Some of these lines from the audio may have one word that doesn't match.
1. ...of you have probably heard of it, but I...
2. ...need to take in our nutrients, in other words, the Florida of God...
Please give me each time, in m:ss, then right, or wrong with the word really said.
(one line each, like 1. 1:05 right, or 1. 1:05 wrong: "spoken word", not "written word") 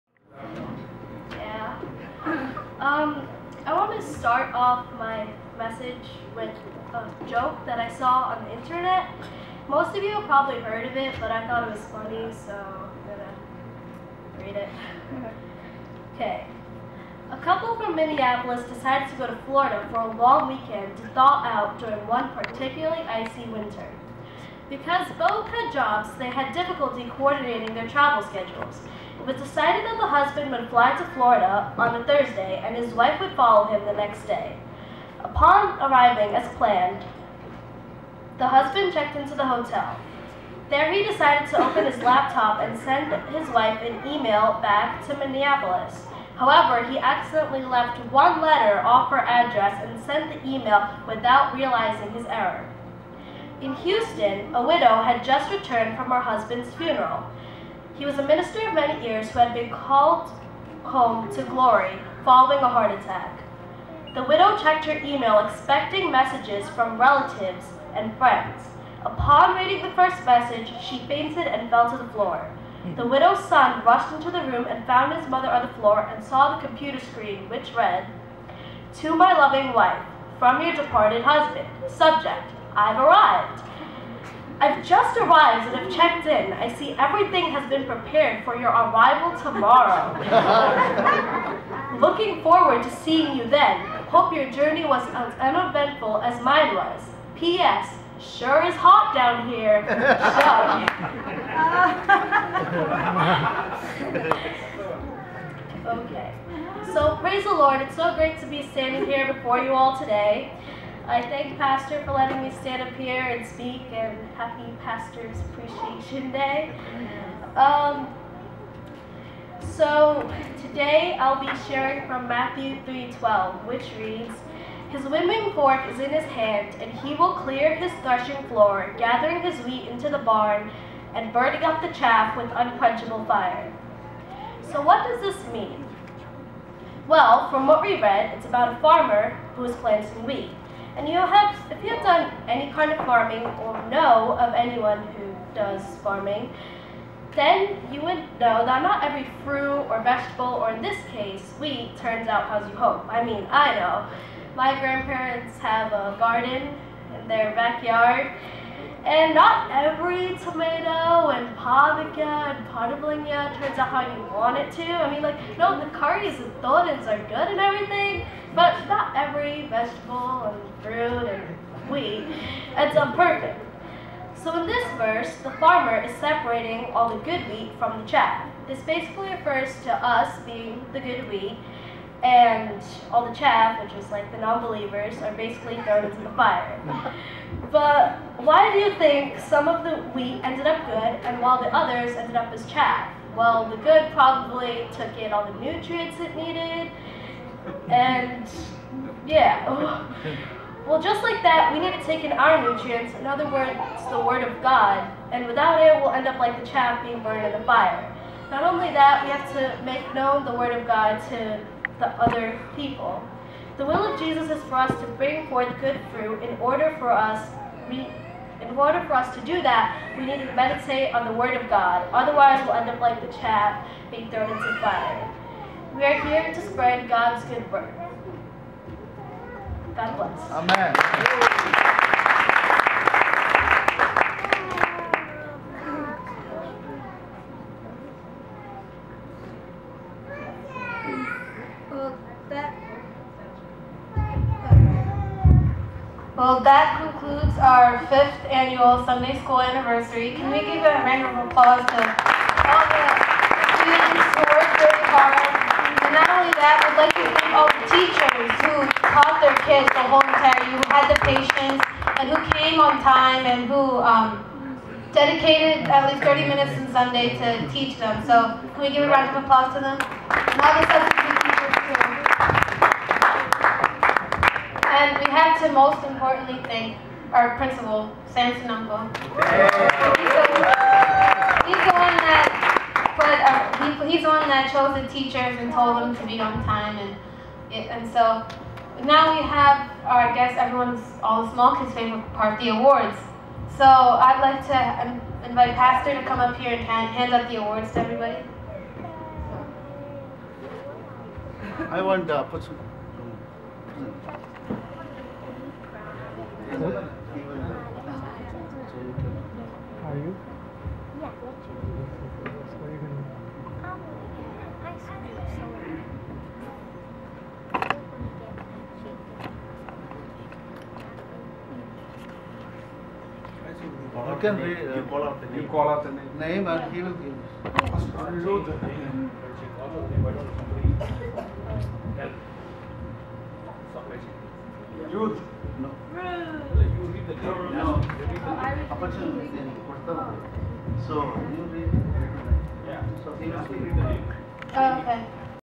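1. 0:09 right
2. 3:21 wrong: "Word", not "Florida".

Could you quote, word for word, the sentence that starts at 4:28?
So can we give a round of applause to them?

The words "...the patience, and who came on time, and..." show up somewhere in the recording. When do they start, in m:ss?
4:21.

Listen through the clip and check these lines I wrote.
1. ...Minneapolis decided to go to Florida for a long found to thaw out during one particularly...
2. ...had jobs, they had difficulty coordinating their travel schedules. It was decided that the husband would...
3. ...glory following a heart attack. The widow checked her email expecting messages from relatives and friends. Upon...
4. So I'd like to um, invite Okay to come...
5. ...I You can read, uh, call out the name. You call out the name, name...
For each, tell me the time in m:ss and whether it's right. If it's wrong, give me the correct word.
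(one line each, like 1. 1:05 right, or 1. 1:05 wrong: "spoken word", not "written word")
1. 0:17 wrong: "weekend", not "found"
2. 0:25 right
3. 1:01 right
4. 4:53 wrong: "Pastor", not "Okay"
5. 5:24 right.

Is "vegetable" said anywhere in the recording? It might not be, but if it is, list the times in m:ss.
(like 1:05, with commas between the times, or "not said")
2:30, 2:49.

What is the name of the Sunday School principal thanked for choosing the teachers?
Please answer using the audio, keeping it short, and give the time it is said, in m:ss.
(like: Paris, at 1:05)
Sam Sonungo, at 4:38.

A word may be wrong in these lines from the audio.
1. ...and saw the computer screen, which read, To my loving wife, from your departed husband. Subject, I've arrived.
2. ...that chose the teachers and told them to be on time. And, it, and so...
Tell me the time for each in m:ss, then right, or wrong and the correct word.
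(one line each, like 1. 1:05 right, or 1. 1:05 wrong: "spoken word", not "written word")
1. 1:15 right
2. 4:44 right.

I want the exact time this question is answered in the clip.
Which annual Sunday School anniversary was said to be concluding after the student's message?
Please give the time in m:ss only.
4:08.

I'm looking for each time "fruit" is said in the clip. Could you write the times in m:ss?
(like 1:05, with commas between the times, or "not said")
2:29, 2:50, 3:36.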